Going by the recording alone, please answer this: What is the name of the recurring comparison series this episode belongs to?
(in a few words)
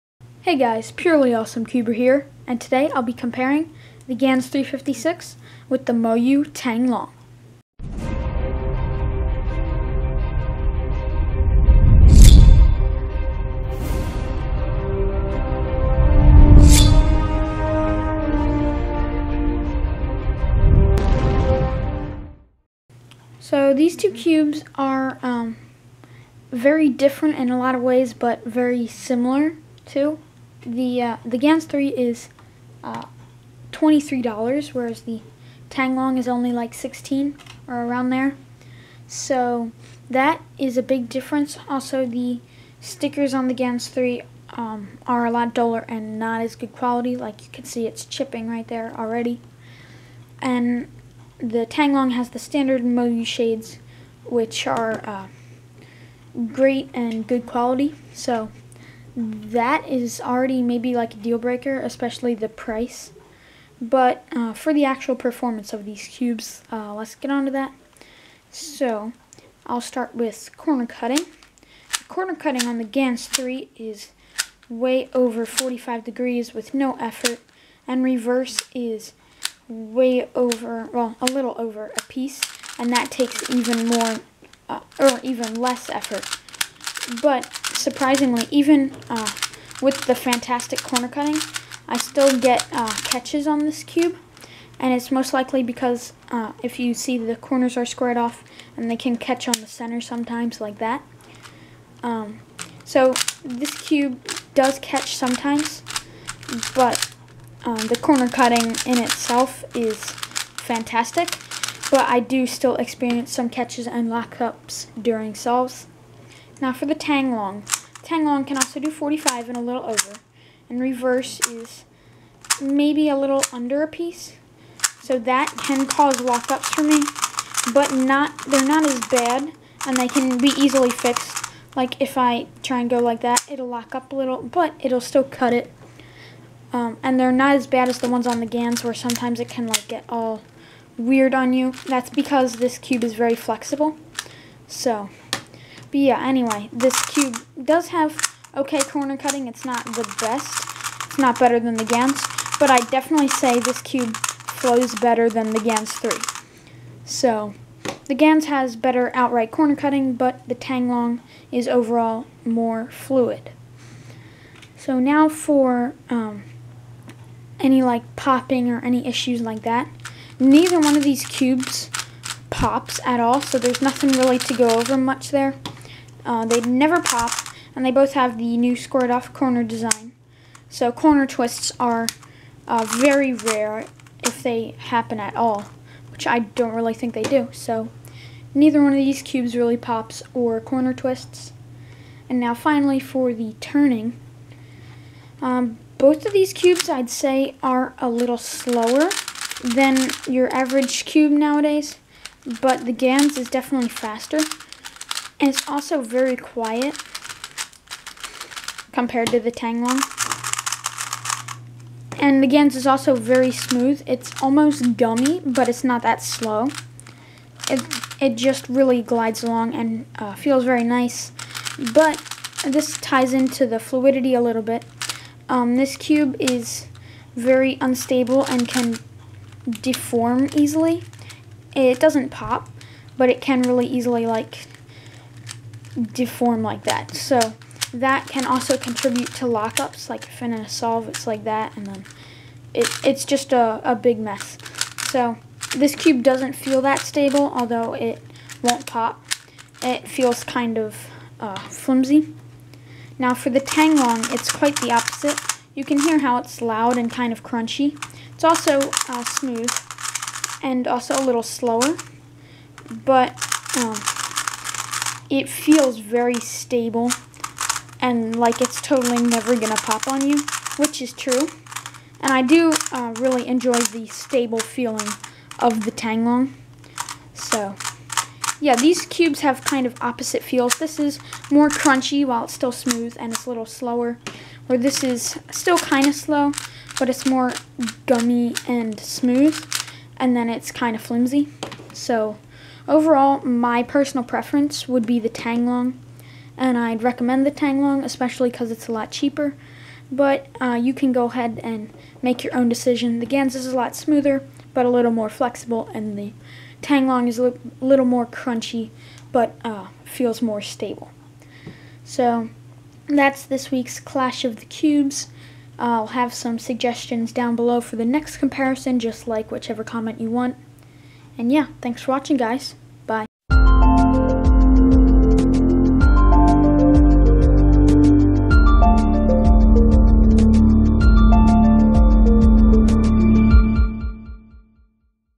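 Clash of the Cubes.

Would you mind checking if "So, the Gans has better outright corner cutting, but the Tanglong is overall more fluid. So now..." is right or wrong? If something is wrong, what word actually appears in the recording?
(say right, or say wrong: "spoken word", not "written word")
right.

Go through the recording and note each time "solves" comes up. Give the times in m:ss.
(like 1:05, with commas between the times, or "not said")
1:55, 4:00.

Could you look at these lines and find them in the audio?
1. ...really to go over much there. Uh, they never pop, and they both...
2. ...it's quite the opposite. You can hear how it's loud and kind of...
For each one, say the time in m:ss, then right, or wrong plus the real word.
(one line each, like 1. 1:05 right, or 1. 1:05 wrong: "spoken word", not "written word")
1. 2:54 right
2. 4:14 right.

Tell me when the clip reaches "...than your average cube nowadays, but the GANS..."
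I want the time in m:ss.
3:19.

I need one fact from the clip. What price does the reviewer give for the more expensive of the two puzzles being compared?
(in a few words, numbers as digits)
$23.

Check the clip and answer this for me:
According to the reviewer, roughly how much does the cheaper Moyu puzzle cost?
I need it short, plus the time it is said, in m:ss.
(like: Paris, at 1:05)
16, at 0:36.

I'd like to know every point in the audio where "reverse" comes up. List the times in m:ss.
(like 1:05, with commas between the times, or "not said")
1:18, 2:00.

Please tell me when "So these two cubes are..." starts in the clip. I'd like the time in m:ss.
0:23.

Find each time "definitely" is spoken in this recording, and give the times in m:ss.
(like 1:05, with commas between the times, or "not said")
2:32, 3:23.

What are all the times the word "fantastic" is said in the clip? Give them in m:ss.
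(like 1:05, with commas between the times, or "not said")
1:30, 1:50.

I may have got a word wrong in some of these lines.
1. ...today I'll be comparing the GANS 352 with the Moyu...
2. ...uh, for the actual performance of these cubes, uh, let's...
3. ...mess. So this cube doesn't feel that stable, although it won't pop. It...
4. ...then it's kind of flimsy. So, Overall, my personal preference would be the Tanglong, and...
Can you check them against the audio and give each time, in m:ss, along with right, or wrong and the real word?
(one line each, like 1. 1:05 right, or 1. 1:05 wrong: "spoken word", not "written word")
1. 0:02 wrong: "356", not "352"
2. 1:04 right
3. 4:04 right
4. 4:50 right.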